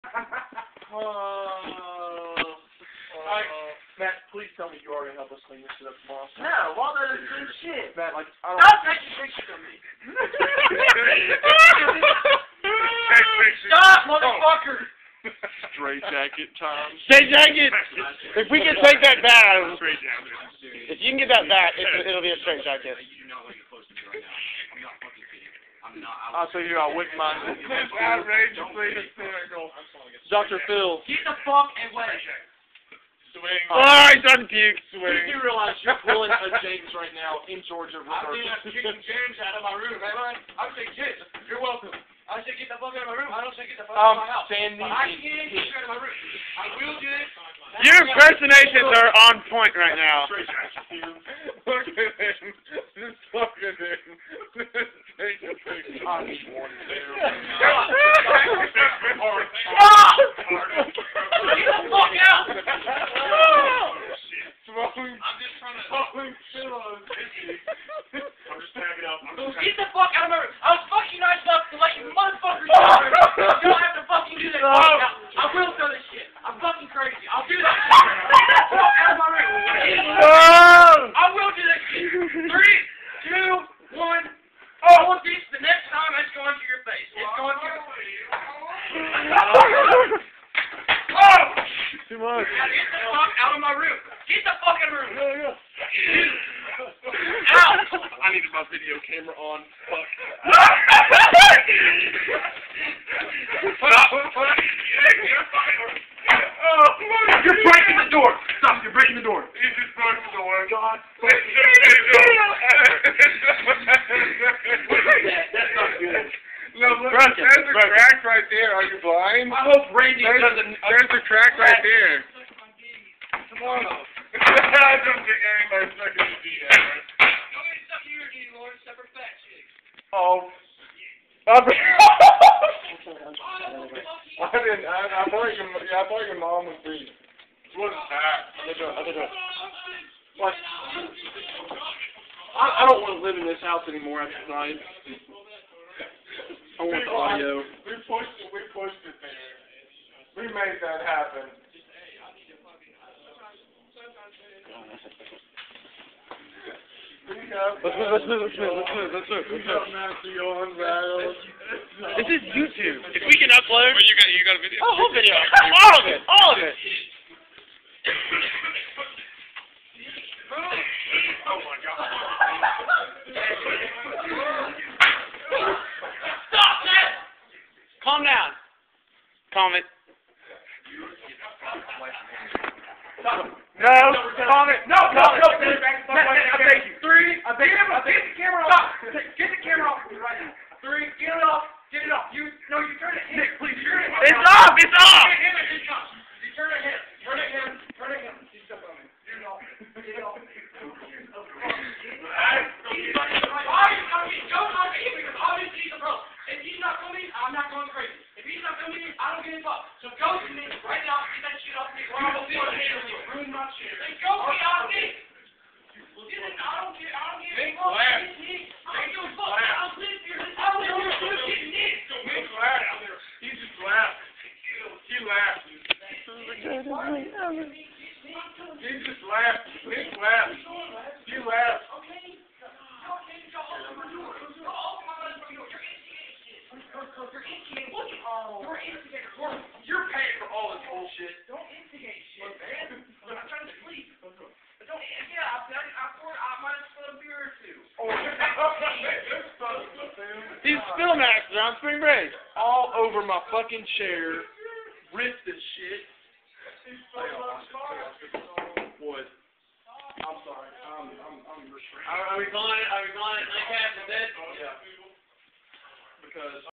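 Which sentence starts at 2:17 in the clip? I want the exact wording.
She wasn't I think I think What?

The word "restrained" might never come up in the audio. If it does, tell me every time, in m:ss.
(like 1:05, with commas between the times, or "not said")
4:21.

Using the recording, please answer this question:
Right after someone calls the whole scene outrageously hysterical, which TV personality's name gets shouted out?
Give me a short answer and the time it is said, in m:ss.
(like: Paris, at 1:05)
Dr. Phil, at 0:30.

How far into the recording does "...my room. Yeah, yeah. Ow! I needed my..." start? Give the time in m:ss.
1:34.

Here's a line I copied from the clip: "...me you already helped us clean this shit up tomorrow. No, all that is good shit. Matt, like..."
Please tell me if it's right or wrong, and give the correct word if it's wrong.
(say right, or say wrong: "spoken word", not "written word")
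right.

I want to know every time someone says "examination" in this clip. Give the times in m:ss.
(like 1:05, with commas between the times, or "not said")
not said.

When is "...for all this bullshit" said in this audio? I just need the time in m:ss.
4:00.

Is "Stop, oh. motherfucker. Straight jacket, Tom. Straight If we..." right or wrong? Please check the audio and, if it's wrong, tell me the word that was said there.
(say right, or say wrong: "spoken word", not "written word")
right.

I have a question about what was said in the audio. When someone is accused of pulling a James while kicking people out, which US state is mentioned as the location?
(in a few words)
Georgia.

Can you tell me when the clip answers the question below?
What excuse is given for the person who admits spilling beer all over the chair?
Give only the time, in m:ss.
4:10.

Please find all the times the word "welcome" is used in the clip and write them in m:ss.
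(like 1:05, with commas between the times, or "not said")
0:41.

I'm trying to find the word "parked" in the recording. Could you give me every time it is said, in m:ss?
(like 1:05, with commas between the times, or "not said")
not said.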